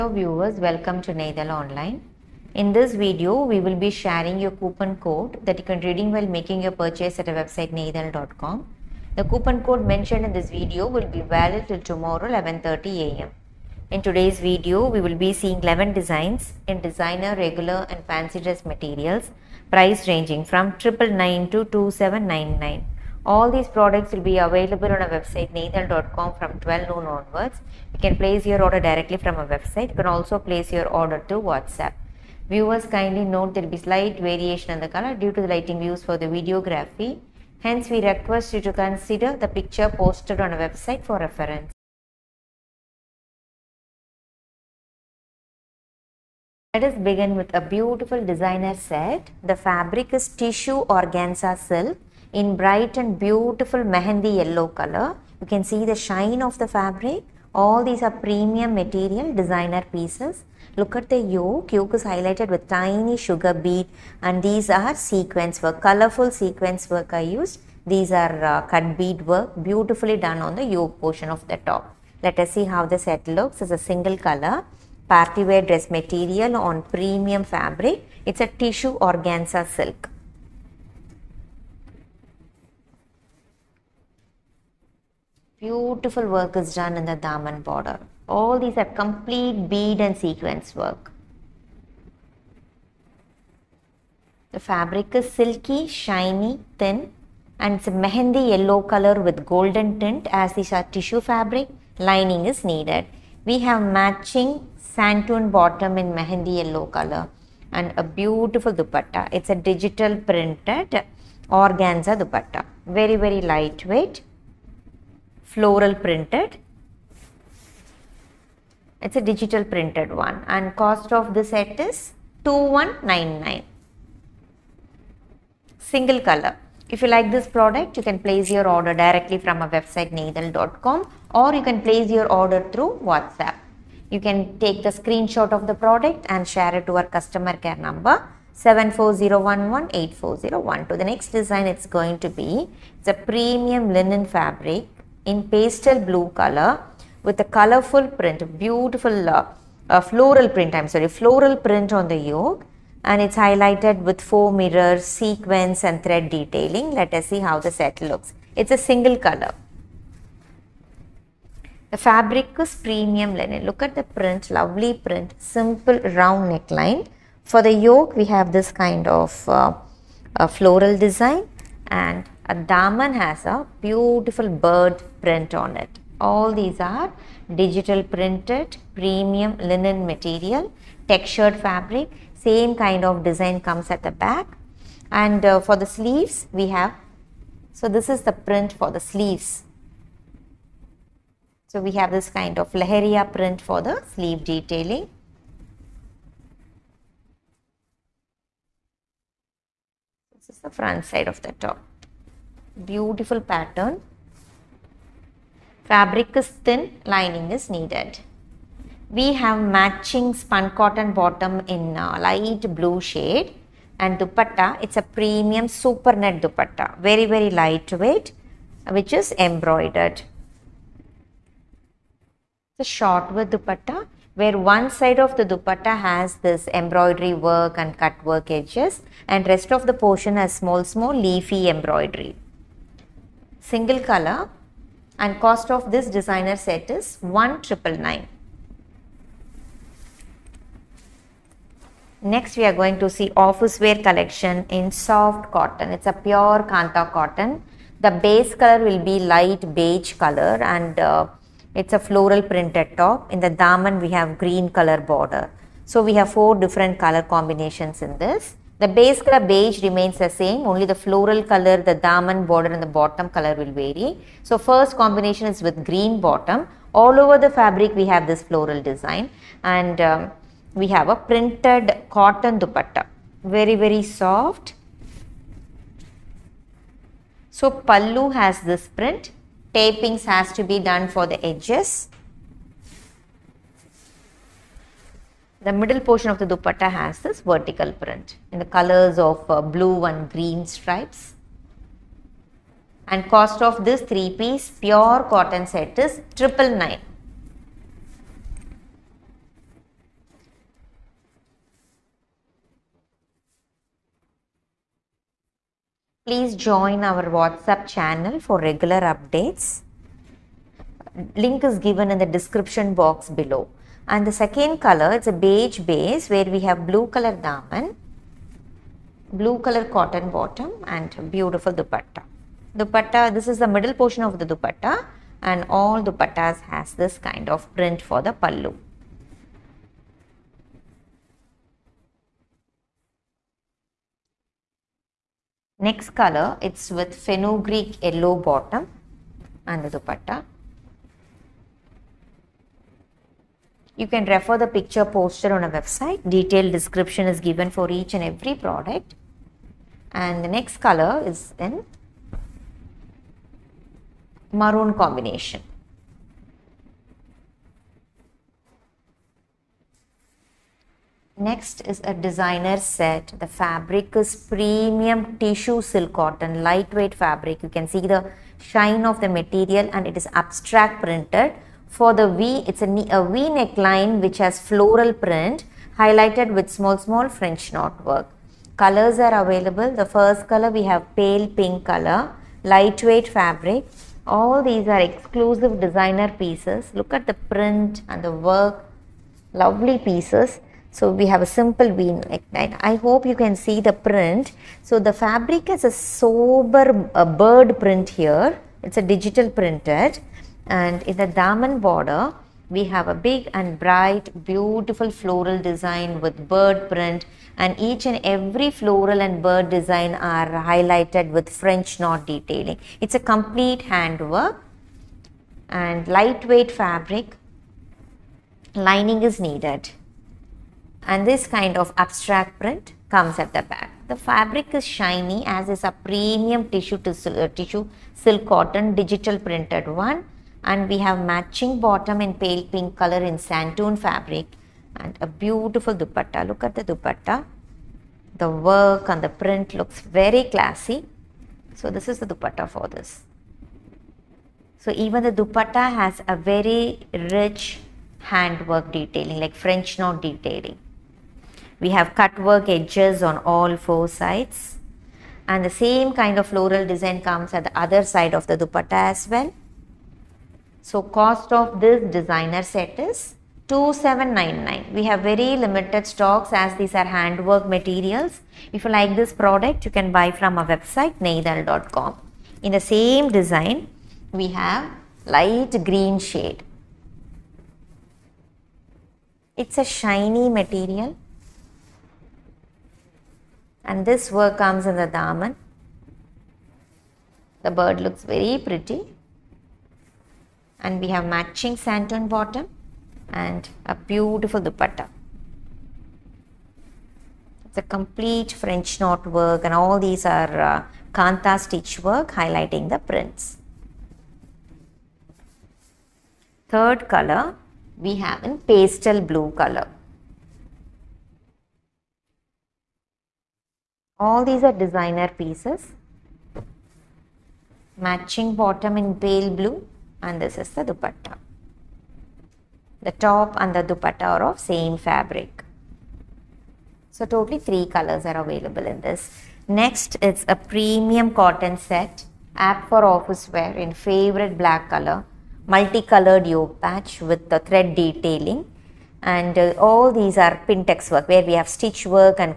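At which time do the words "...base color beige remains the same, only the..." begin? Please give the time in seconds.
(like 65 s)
258 s.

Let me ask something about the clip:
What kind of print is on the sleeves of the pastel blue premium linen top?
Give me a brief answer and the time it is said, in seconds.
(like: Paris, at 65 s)
leheria print, at 192 s.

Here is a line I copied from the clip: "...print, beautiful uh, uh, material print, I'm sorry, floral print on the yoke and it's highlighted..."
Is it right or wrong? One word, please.
wrong.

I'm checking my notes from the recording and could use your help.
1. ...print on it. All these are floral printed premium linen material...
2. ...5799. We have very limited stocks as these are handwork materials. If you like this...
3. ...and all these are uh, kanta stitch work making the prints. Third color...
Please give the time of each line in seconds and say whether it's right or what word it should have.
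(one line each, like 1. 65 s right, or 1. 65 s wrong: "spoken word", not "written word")
1. 175 s wrong: "digital", not "floral"
2. 463 s wrong: "2799", not "5799"
3. 499 s wrong: "highlighting", not "making".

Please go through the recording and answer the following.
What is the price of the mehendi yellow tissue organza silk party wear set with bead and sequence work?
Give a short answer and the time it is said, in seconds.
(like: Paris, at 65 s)
2199, at 122 s.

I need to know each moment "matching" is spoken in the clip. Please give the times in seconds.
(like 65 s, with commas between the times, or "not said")
103 s, 209 s, 431 s, 491 s, 517 s.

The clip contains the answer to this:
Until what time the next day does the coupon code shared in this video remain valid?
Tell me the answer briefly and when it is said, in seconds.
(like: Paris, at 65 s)
11:30 am, at 12 s.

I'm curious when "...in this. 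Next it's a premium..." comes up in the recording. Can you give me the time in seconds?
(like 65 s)
528 s.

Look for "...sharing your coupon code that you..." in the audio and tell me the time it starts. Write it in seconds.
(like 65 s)
3 s.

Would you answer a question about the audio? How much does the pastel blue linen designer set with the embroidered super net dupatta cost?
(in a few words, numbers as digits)
1999.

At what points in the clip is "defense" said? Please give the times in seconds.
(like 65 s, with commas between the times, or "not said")
not said.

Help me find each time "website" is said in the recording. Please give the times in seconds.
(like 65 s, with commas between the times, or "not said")
7 s, 25 s, 29 s, 40 s, 129 s, 345 s, 470 s.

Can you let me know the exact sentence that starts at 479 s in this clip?
It's a shiny material and this work comes in the daman.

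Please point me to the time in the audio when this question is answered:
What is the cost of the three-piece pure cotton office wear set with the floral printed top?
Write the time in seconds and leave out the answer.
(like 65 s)
296 s.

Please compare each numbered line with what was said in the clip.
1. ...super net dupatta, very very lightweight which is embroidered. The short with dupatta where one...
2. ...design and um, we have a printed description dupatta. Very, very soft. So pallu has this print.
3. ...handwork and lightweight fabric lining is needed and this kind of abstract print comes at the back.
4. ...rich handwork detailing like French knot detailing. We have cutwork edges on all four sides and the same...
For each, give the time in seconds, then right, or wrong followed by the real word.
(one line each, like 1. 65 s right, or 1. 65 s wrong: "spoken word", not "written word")
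1. 215 s right
2. 268 s wrong: "cotton", not "description"
3. 413 s right
4. 447 s right.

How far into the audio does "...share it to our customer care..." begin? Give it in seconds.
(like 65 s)
136 s.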